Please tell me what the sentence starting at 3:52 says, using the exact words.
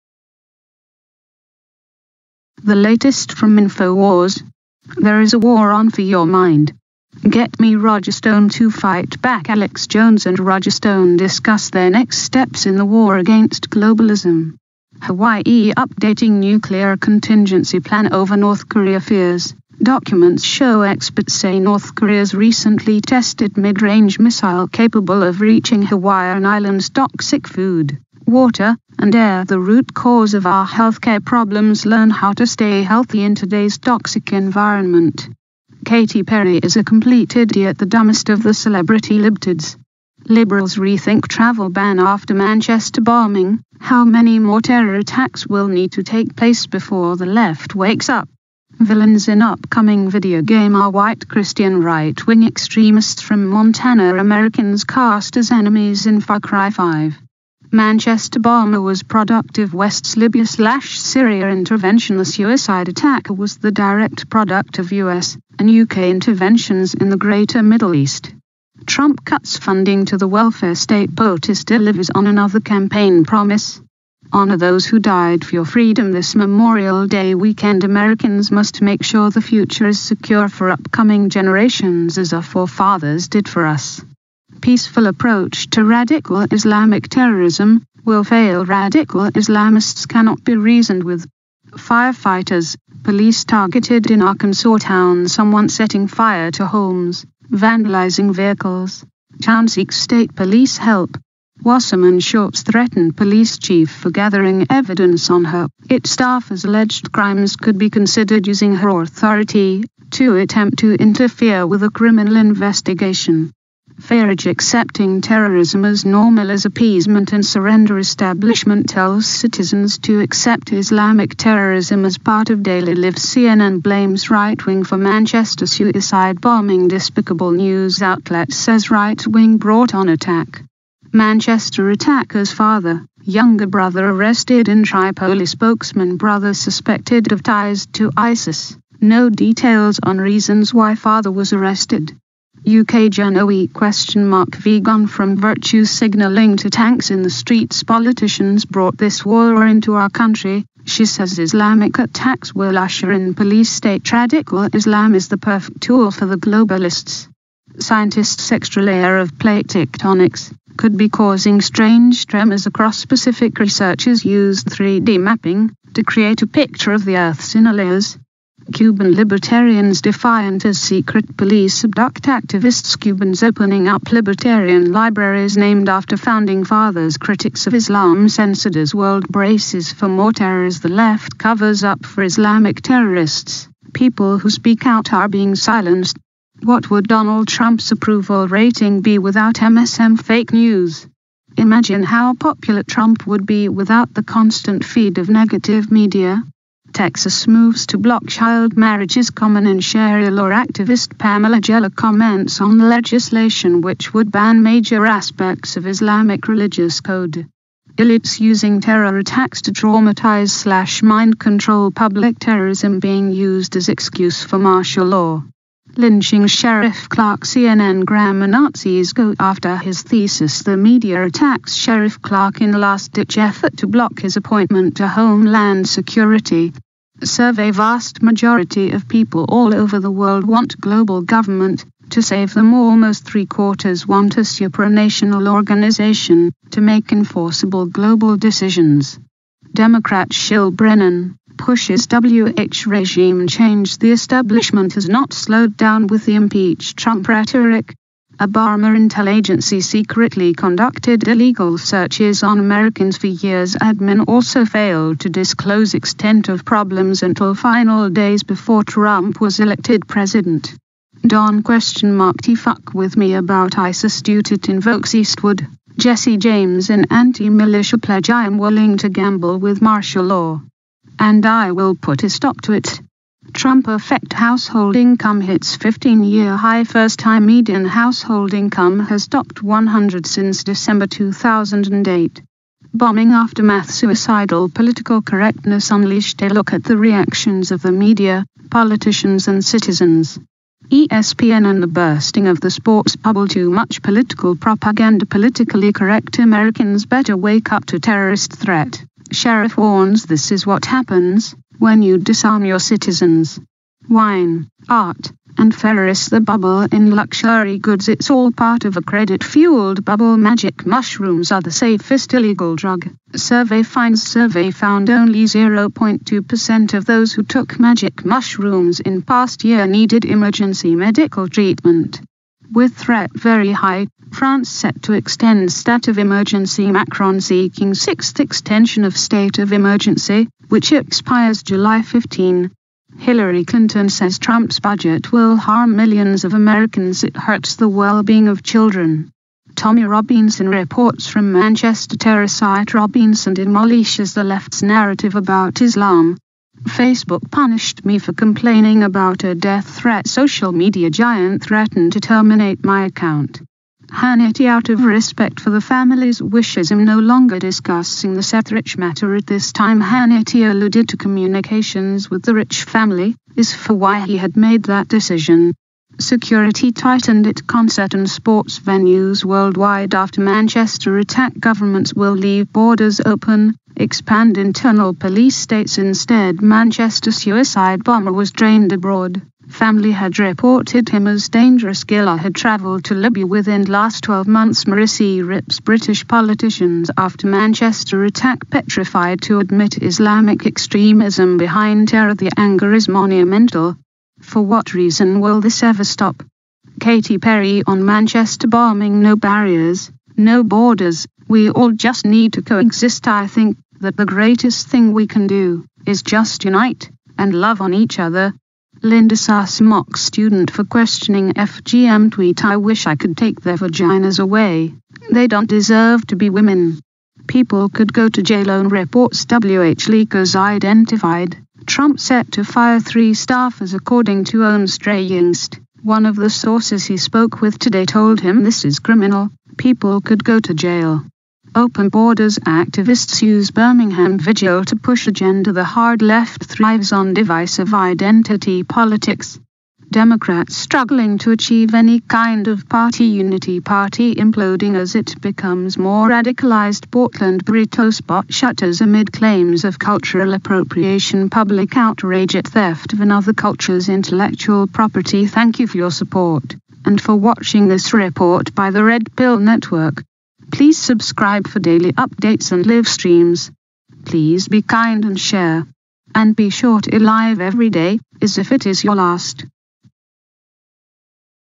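To save them almost three-quarters want a supranational organization to make enforceable global decisions.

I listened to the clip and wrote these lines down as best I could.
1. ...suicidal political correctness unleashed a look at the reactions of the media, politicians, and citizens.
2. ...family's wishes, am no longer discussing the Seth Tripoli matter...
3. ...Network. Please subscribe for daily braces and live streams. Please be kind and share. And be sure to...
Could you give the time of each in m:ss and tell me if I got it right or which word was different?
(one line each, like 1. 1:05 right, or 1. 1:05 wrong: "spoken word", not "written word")
1. 4:43 right
2. 5:55 wrong: "Rich", not "Tripoli"
3. 7:39 wrong: "updates", not "braces".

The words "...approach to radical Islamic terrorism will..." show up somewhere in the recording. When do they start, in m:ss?
1:25.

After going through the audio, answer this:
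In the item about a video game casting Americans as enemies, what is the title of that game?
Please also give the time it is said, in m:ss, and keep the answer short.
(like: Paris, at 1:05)
Far Cry 5, at 0:56.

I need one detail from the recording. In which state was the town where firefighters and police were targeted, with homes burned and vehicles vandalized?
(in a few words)
Arkansas.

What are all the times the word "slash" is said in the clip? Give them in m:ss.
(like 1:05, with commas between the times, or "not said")
1:00, 3:30.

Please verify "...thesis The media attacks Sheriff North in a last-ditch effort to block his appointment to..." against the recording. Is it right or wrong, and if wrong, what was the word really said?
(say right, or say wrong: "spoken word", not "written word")
wrong: "Clarke", not "North".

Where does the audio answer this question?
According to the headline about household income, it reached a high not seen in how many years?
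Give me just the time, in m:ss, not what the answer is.
4:35.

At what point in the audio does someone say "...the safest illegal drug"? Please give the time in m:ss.
5:11.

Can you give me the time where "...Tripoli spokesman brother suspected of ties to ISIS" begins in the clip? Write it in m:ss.
2:14.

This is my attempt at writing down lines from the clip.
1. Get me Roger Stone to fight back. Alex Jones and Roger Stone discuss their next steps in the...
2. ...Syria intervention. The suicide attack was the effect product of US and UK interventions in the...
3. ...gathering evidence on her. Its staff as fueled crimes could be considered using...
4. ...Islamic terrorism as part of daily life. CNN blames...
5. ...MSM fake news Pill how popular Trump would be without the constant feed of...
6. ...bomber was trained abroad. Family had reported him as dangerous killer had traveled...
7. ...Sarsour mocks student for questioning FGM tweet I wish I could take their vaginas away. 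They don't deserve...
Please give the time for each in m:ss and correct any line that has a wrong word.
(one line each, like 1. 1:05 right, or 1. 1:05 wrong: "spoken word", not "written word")
1. 0:07 right
2. 1:00 wrong: "direct", not "effect"
3. 1:44 wrong: "alleged", not "fueled"
4. 2:00 right
5. 3:09 wrong: "Imagine", not "Pill"
6. 6:18 right
7. 6:49 right.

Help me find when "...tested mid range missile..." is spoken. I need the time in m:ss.
0:23.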